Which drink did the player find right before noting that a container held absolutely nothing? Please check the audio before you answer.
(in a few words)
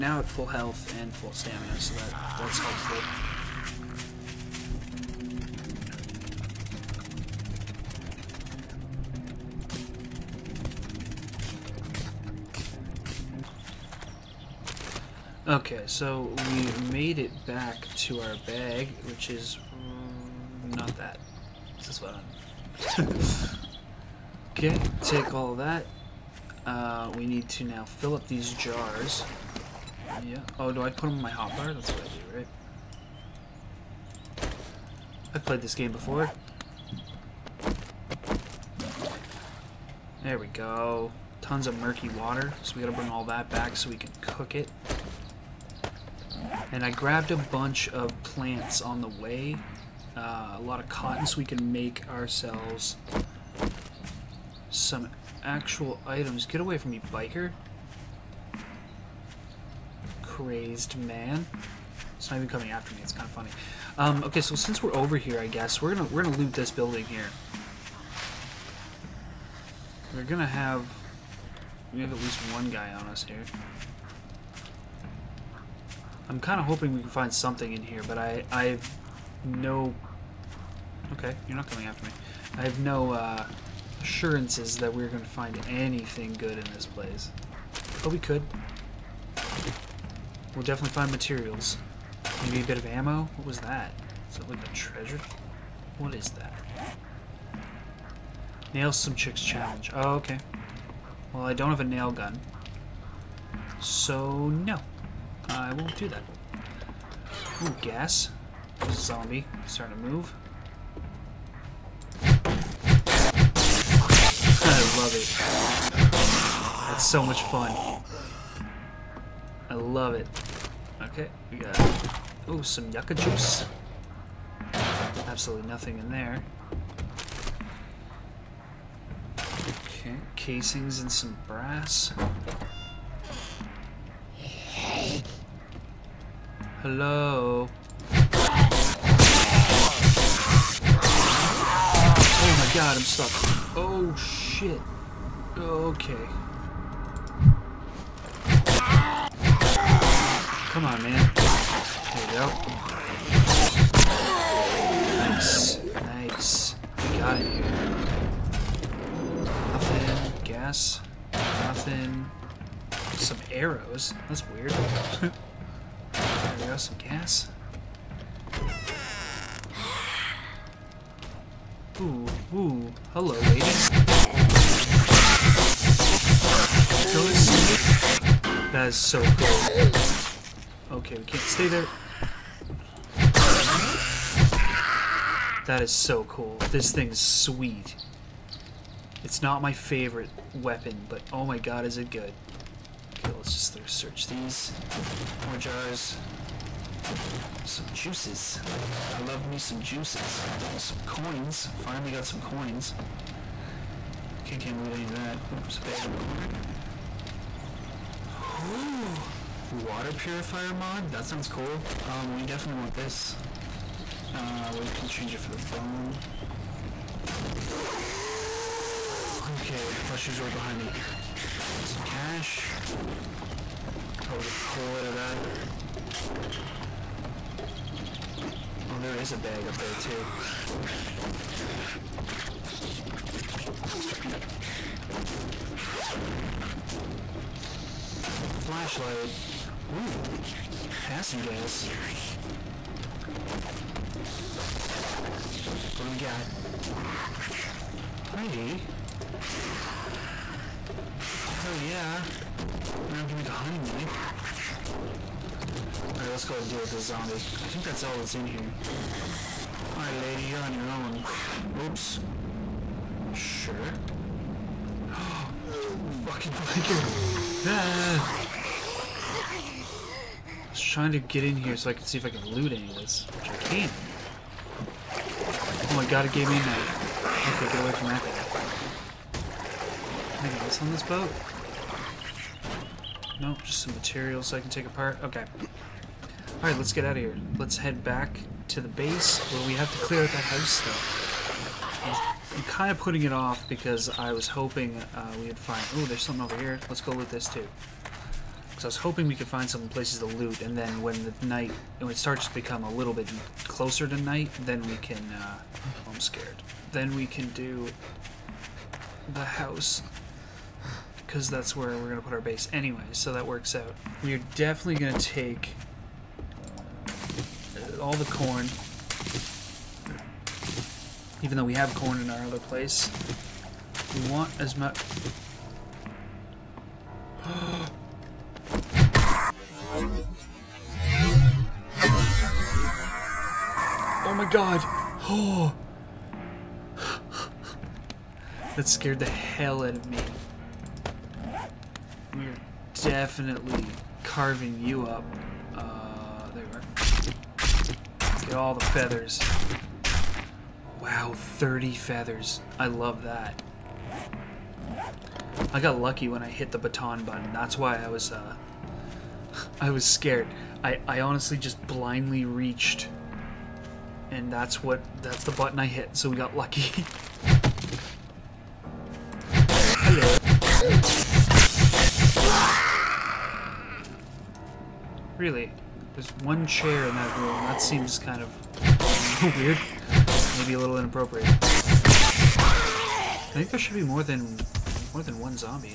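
yucca juice.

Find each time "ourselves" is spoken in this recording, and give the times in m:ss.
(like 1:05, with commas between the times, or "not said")
0:52.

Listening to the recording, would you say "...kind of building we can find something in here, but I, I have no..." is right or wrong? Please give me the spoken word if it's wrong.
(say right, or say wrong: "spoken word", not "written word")
wrong: "hoping", not "building".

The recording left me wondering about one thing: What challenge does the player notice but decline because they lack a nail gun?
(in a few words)
Nail some chicks challenge.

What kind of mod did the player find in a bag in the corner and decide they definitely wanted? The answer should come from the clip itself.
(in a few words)
water purifier mod.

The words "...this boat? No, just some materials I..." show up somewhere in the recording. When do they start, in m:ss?
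4:40.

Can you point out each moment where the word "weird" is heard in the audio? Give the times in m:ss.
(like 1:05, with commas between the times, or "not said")
2:44, 6:19.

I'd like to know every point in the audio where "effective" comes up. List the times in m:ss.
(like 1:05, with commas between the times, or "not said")
not said.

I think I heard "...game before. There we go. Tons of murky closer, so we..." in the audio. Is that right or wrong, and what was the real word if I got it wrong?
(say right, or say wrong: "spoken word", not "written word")
wrong: "water", not "closer".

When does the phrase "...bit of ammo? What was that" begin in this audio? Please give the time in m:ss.
1:32.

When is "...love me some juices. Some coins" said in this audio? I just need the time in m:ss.
3:19.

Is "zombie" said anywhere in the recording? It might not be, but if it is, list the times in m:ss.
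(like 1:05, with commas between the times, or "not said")
1:48, 4:17.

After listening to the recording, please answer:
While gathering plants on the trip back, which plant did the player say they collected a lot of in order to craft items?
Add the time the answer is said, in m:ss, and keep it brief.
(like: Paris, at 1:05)
cotton, at 0:50.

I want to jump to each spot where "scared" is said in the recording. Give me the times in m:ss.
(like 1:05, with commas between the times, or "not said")
5:06, 5:38, 6:00.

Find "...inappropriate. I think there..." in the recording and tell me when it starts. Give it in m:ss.
6:20.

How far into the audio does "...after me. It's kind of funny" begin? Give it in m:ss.
1:02.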